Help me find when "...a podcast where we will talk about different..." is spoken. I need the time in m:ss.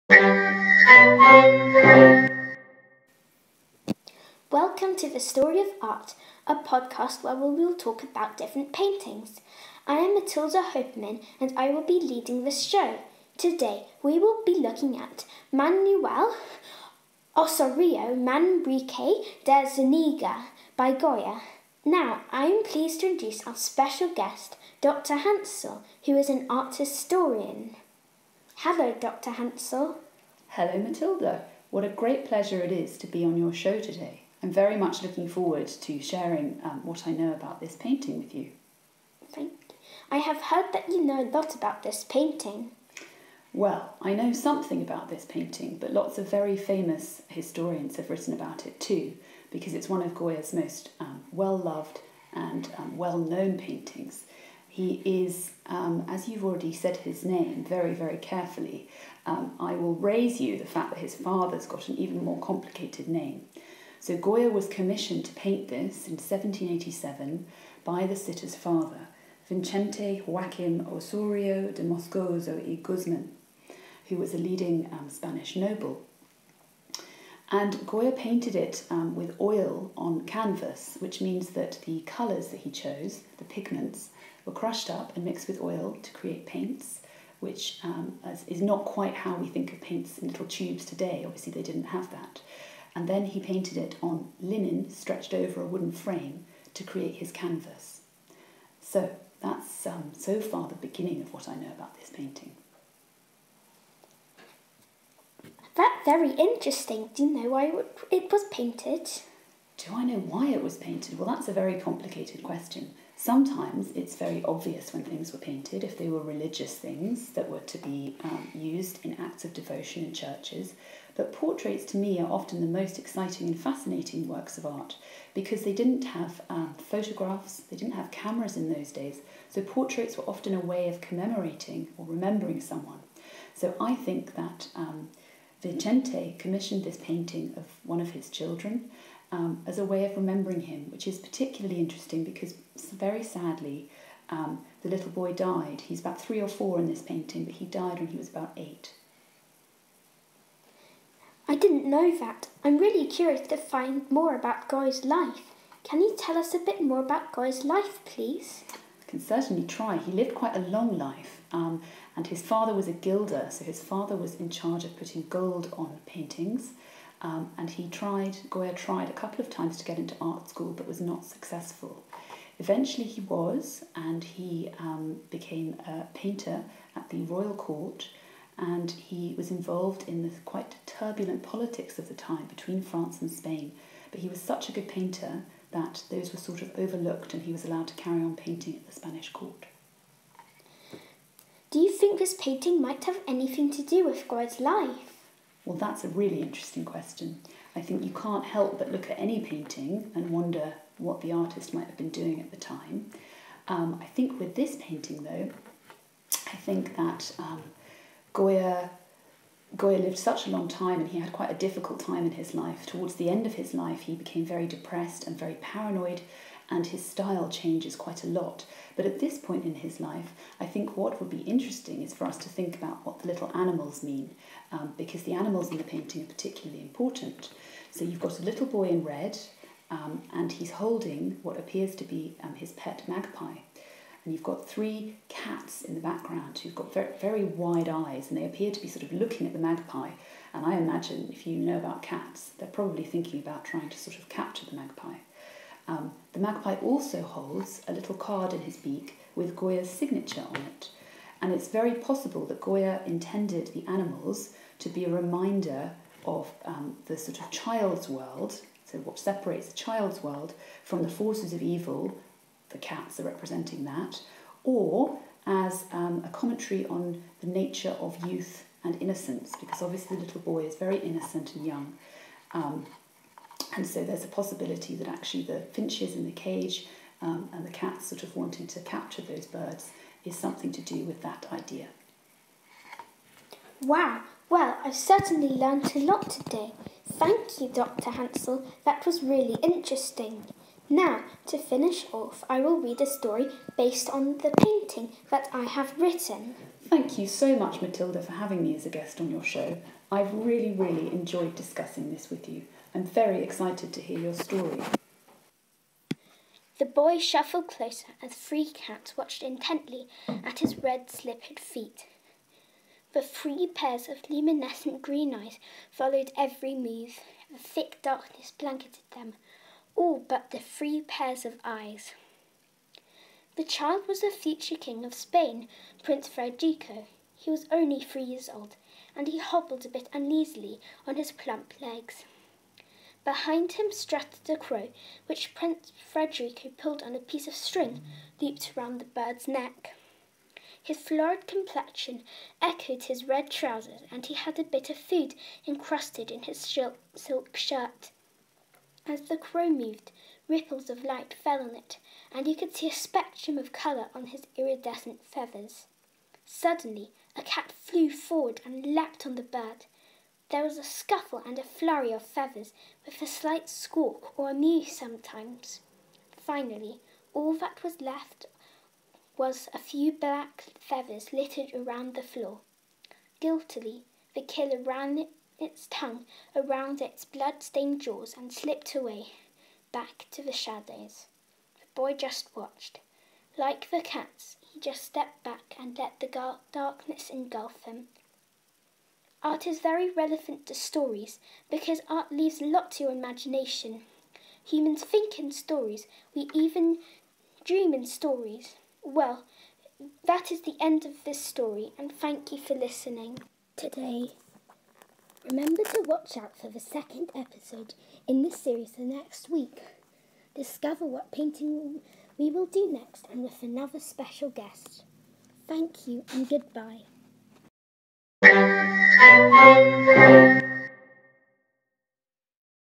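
0:06.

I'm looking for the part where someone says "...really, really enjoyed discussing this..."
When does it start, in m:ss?
5:00.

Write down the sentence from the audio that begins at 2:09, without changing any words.
So portraits were often a way of commemorating or remembering someone.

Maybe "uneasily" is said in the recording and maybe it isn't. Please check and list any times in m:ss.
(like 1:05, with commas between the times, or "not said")
5:30.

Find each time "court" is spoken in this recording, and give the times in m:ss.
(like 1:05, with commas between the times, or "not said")
2:57, 3:09.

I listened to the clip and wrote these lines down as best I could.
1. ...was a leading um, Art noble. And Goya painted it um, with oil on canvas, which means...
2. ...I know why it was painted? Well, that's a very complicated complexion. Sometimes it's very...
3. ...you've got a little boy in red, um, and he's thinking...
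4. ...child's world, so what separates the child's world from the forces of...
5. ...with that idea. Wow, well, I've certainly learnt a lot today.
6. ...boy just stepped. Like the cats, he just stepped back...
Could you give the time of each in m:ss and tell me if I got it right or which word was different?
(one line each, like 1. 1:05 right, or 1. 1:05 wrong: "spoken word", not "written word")
1. 1:14 wrong: "Spanish", not "Art"
2. 1:49 wrong: "question", not "complexion"
3. 3:48 wrong: "holding", not "thinking"
4. 4:17 right
5. 4:41 right
6. 6:21 wrong: "watched", not "stepped".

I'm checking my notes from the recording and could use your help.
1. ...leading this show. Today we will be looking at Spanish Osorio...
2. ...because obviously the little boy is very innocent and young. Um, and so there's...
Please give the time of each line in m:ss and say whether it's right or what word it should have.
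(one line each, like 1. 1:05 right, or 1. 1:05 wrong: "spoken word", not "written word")
1. 0:12 wrong: "Manuel", not "Spanish"
2. 4:29 right.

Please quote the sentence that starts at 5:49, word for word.
As the crow moved, ripples of light fell on it, and you could see a spectrum of colour on his iridescent feathers.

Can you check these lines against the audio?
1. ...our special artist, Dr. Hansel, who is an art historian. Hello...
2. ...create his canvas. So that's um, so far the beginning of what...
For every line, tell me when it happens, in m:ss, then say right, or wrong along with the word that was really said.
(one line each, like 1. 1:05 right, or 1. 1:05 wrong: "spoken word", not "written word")
1. 0:23 wrong: "guest", not "artist"
2. 1:36 right.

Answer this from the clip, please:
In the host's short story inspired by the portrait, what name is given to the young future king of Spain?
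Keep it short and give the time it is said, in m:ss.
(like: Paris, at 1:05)
Prince Frederico, at 5:26.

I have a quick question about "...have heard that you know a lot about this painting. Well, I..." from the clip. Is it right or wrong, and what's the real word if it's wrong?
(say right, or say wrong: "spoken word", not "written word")
right.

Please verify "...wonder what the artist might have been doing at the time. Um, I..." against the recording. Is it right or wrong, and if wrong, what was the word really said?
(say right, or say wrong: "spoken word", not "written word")
right.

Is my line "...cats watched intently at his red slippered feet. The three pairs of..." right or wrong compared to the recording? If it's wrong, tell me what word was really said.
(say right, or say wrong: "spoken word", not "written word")
right.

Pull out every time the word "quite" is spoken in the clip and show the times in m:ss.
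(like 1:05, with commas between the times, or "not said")
1:28, 2:40, 3:00, 3:31, 3:37.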